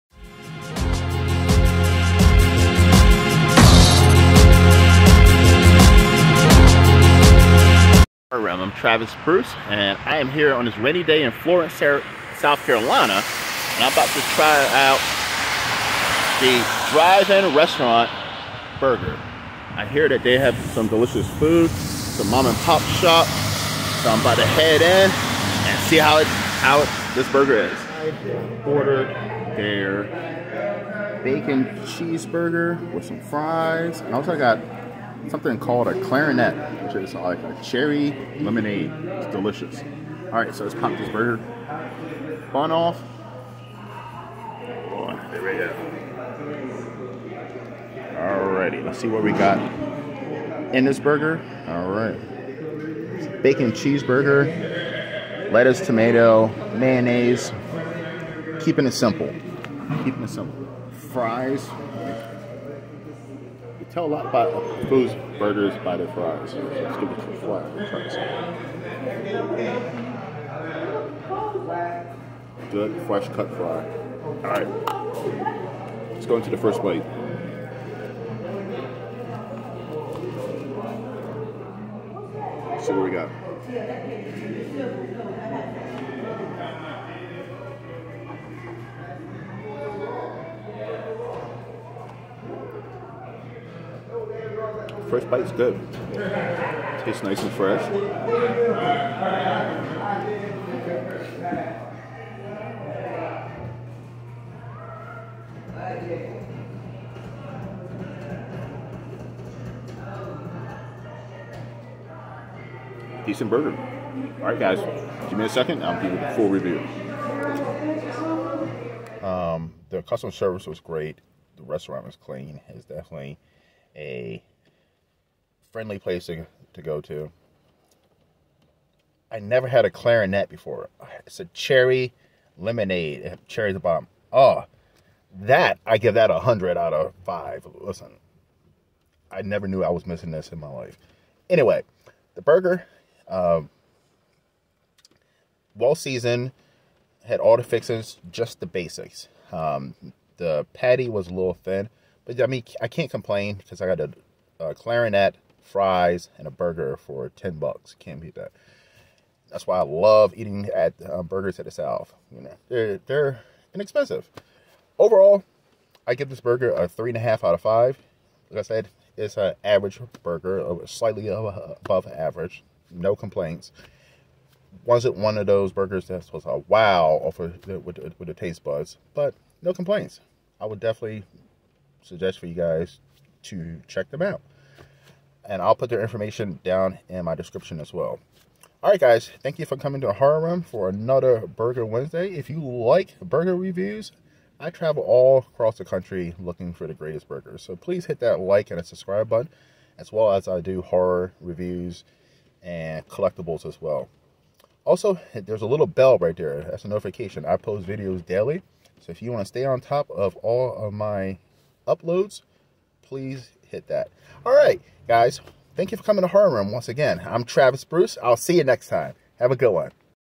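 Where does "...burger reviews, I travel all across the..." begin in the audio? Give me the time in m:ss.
3:13.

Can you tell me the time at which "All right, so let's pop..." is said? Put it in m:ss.
0:40.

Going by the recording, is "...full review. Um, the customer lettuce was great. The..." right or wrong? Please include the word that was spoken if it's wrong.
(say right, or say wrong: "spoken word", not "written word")
wrong: "service", not "lettuce".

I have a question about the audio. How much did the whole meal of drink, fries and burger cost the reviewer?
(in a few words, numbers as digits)
$10.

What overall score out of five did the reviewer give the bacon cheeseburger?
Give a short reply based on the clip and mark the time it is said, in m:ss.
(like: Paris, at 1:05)
3.5, at 2:46.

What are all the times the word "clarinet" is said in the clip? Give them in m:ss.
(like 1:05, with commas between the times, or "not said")
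0:36, 2:09, 2:34.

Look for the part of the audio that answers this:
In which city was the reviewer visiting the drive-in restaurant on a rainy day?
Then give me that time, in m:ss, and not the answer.
0:11.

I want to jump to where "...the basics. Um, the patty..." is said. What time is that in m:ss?
2:28.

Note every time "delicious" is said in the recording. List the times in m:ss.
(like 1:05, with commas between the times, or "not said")
0:20, 0:39.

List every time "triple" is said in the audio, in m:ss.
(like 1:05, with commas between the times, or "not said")
not said.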